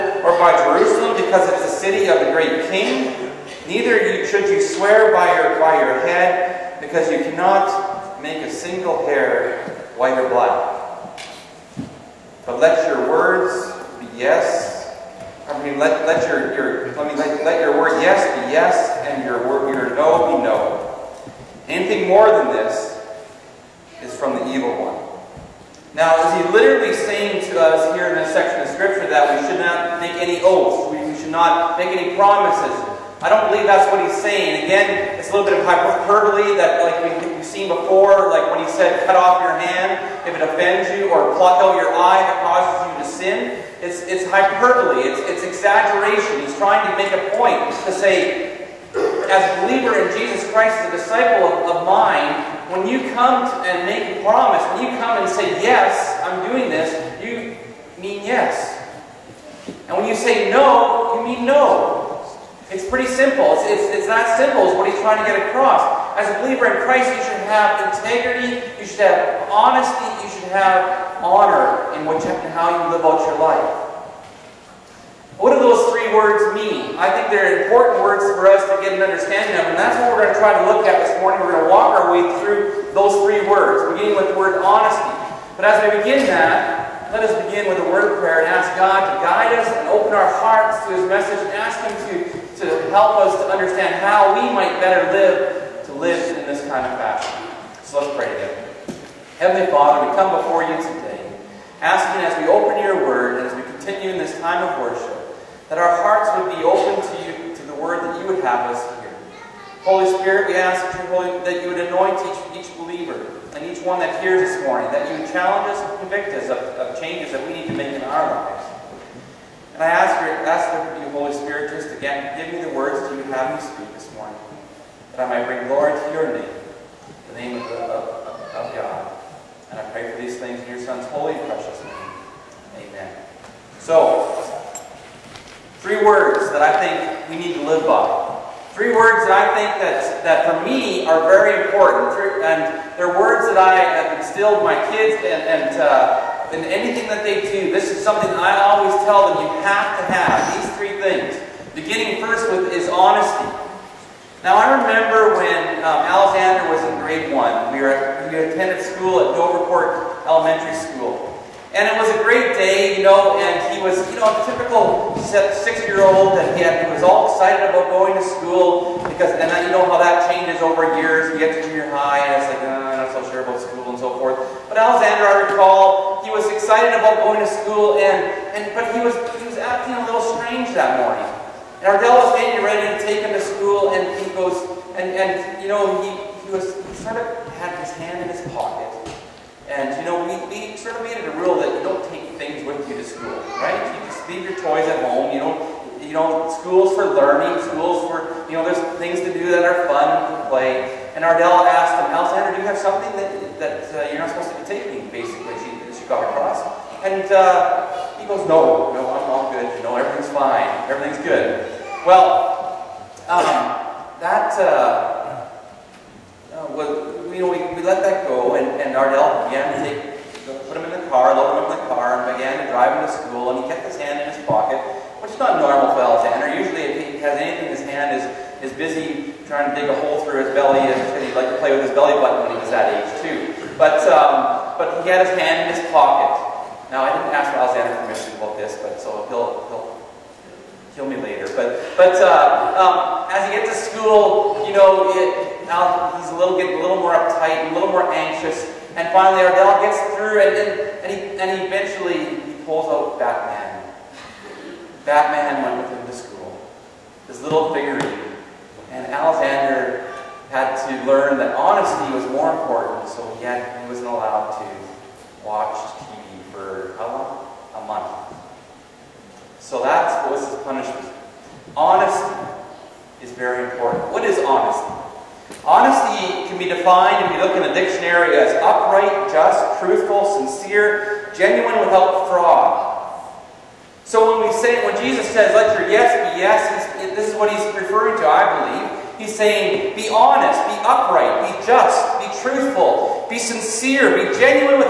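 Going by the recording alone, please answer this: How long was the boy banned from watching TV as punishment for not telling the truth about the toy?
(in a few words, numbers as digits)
A month.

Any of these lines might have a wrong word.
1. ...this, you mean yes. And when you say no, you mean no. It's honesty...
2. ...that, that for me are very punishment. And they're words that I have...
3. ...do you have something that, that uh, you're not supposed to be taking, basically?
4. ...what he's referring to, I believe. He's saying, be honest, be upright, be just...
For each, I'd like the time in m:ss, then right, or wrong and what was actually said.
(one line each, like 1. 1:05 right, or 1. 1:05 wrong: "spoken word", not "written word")
1. 0:56 wrong: "pretty", not "honesty"
2. 2:19 wrong: "important", not "punishment"
3. 3:22 right
4. 4:47 right.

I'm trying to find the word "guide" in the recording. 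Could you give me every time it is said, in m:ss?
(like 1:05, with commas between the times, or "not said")
1:29.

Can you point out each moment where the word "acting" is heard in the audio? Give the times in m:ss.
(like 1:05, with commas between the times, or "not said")
2:59.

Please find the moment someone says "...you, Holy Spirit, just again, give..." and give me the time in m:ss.
2:01.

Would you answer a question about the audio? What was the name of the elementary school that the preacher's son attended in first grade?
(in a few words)
Dovercourt Elementary School.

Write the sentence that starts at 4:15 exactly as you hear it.
Batman went with him to school, his little figurine.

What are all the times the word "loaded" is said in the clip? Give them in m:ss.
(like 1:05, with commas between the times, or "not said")
3:41.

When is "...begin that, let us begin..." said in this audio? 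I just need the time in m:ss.
1:26.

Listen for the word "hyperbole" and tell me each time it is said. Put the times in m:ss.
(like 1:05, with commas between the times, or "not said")
0:35, 0:44.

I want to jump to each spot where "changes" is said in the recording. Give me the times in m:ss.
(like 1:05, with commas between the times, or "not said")
1:56, 2:50.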